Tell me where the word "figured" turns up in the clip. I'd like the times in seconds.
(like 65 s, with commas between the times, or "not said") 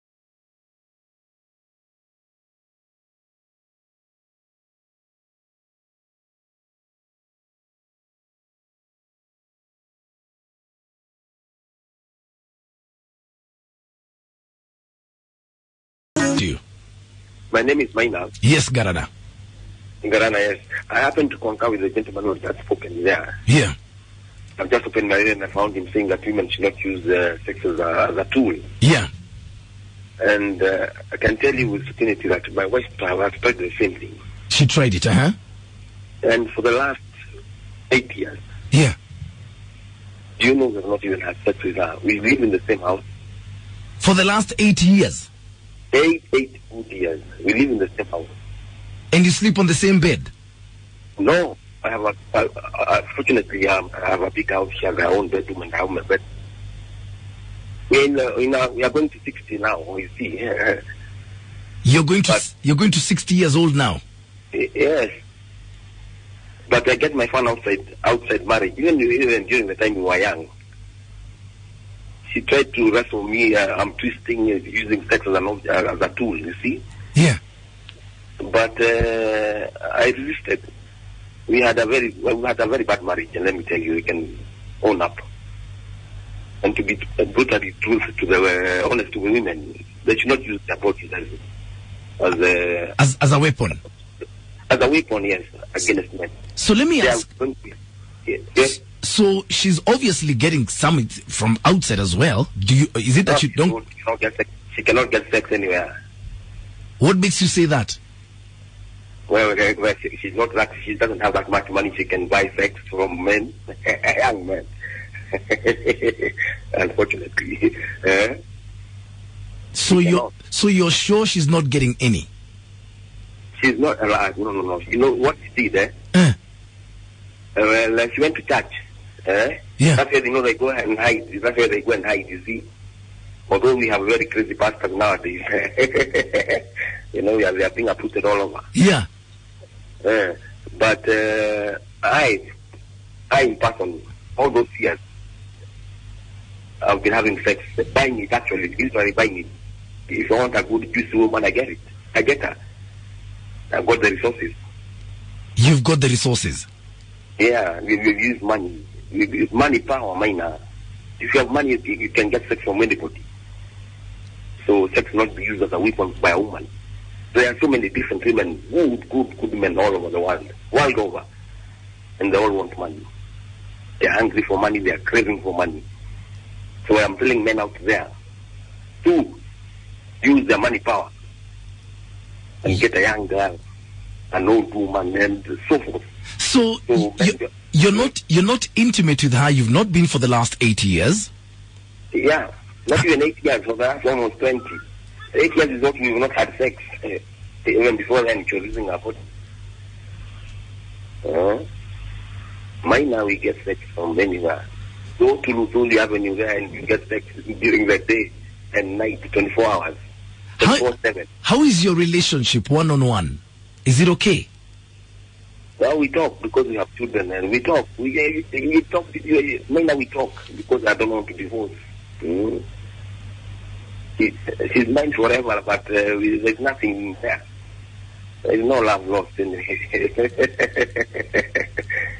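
not said.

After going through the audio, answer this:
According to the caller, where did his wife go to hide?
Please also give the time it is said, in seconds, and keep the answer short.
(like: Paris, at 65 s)
church, at 128 s.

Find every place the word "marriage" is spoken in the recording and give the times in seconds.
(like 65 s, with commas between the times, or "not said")
68 s, 83 s.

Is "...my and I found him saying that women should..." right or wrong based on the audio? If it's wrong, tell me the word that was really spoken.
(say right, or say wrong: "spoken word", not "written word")
right.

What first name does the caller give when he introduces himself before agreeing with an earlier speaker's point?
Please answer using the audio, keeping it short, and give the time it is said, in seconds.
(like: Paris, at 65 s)
Maina, at 17 s.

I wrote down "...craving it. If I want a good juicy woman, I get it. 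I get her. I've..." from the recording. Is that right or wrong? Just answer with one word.
wrong.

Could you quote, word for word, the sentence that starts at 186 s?
So, so you, uh, you're not you're not intimate with her.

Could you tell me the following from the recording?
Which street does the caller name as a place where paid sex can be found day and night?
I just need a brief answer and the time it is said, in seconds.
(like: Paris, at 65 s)
Luthuli Avenue, at 205 s.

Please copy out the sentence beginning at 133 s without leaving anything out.
Although we have very crazy pastors nowadays.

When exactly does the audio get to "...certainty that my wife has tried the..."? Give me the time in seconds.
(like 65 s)
31 s.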